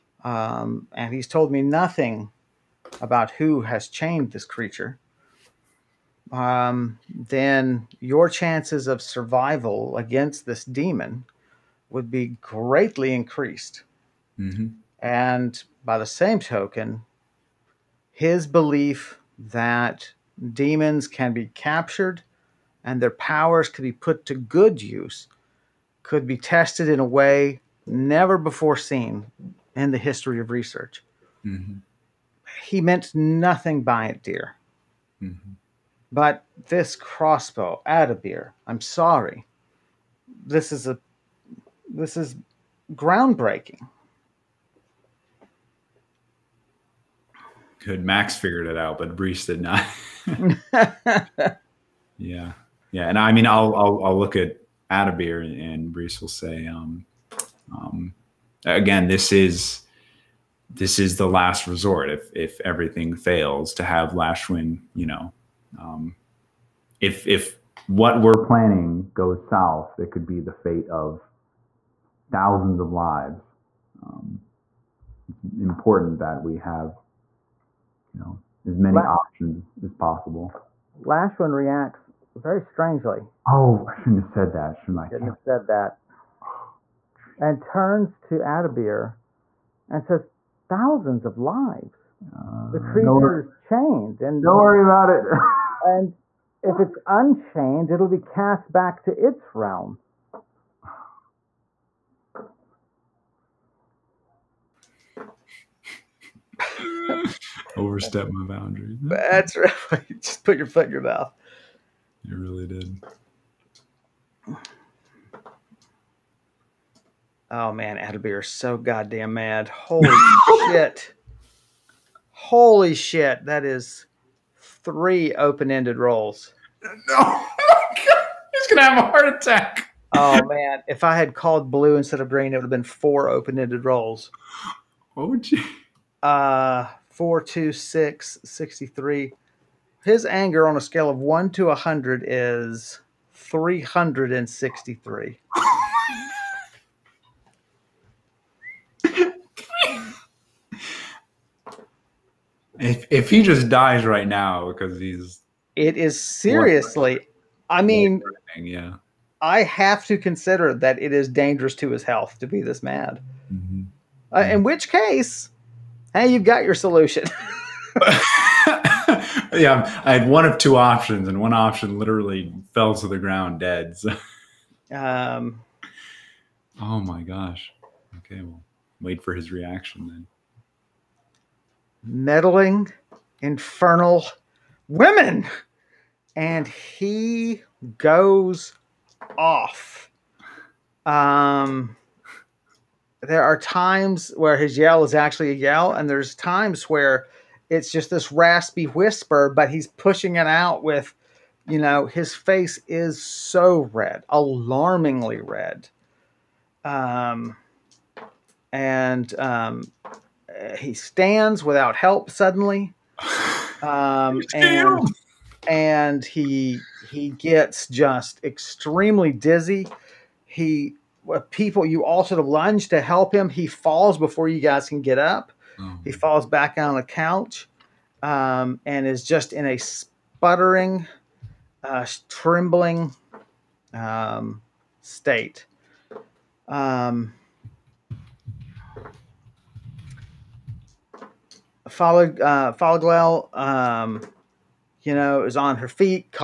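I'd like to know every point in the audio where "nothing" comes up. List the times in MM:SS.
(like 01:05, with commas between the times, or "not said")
00:01, 00:33.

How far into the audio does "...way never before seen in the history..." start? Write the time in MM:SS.
00:27.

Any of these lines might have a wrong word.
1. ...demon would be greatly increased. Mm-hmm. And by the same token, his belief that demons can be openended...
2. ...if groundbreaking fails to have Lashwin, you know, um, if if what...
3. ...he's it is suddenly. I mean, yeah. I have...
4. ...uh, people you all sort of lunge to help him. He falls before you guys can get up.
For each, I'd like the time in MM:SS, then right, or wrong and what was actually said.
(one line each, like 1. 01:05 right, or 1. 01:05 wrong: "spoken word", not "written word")
1. 00:10 wrong: "captured", not "openended"
2. 01:02 wrong: "everything", not "groundbreaking"
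3. 02:34 wrong: "seriously", not "suddenly"
4. 03:41 right.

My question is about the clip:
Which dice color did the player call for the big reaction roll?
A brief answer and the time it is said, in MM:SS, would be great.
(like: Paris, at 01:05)
Green, at 02:12.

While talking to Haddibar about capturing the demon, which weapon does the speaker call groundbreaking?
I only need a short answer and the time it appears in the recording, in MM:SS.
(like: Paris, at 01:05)
Crossbow, at 00:36.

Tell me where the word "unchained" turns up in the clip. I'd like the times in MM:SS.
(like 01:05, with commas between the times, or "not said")
01:37.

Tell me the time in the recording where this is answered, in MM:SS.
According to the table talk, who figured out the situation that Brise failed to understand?
00:48.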